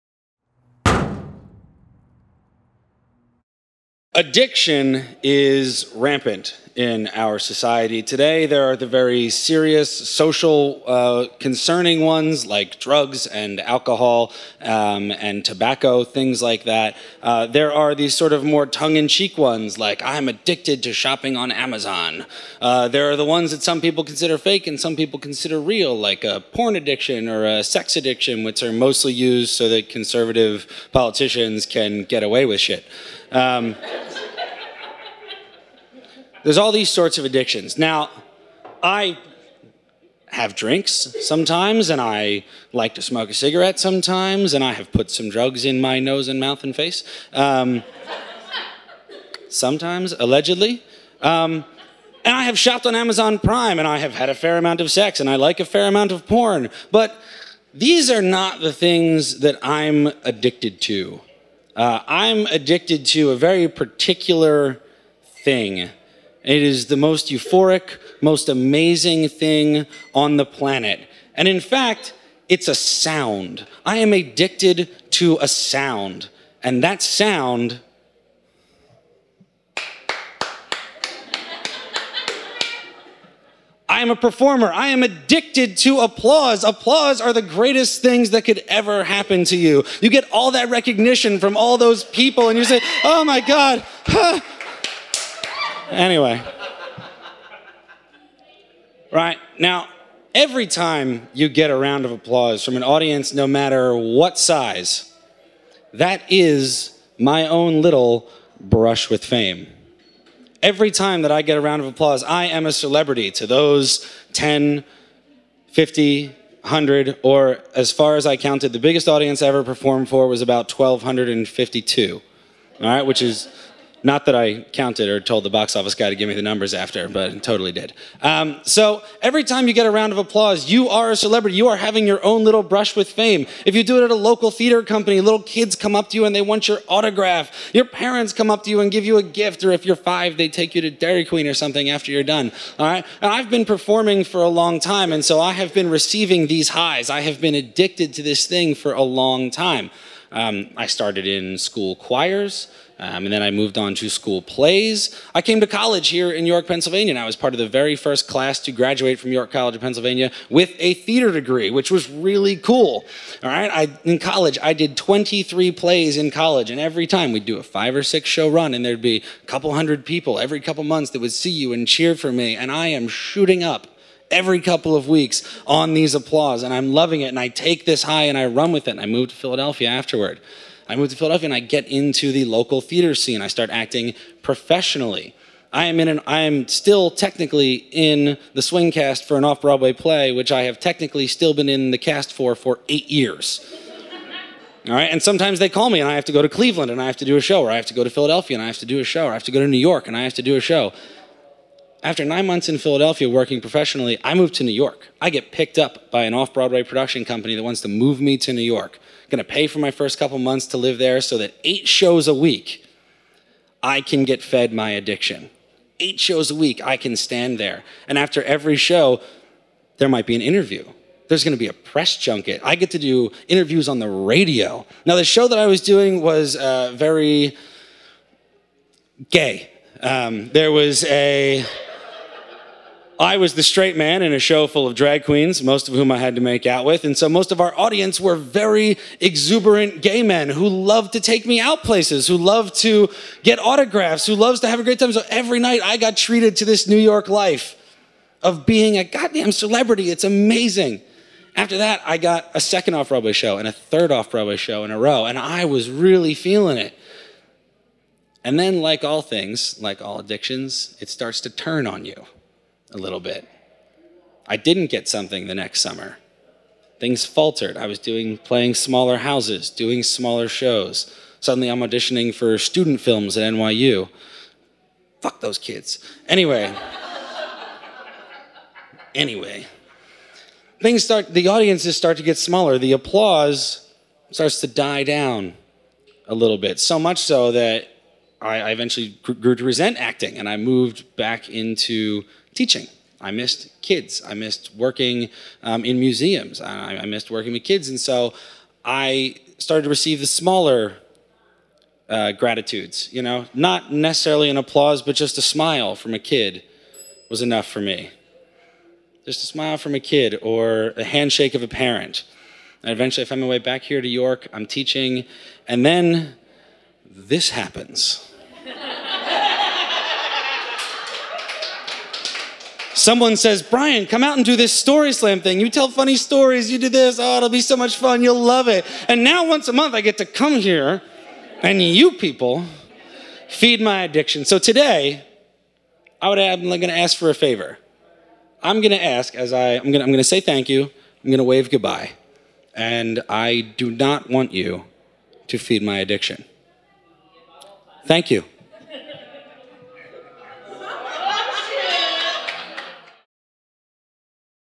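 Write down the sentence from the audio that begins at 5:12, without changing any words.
And eventually I found my way back here to York.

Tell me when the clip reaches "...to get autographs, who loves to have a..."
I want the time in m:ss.
4:02.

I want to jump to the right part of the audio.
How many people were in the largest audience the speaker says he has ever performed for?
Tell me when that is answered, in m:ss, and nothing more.
2:00.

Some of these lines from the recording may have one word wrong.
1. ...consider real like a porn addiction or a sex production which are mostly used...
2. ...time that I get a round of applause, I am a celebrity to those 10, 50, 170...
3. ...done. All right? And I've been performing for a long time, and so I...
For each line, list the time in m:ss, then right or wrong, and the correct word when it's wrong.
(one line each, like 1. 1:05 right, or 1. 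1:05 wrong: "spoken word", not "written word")
1. 0:25 wrong: "addiction", not "production"
2. 1:50 wrong: "100", not "170"
3. 2:22 right.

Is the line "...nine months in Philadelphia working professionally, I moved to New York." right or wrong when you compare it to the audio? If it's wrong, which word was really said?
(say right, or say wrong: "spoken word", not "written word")
right.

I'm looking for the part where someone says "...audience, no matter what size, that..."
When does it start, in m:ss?
1:42.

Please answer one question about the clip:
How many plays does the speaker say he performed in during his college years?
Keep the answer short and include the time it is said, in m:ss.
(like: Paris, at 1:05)
23, at 2:44.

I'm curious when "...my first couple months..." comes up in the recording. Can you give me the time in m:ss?
3:29.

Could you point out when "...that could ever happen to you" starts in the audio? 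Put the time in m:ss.
1:28.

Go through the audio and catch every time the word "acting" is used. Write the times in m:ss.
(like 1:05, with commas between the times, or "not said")
3:03, 4:49.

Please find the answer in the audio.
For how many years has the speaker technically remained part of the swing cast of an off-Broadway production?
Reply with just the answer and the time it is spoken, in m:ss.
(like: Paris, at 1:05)
8, at 3:12.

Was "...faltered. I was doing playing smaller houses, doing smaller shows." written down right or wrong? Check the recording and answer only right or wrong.
right.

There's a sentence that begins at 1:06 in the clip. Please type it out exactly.
It is the most euphoric, most amazing thing on the planet.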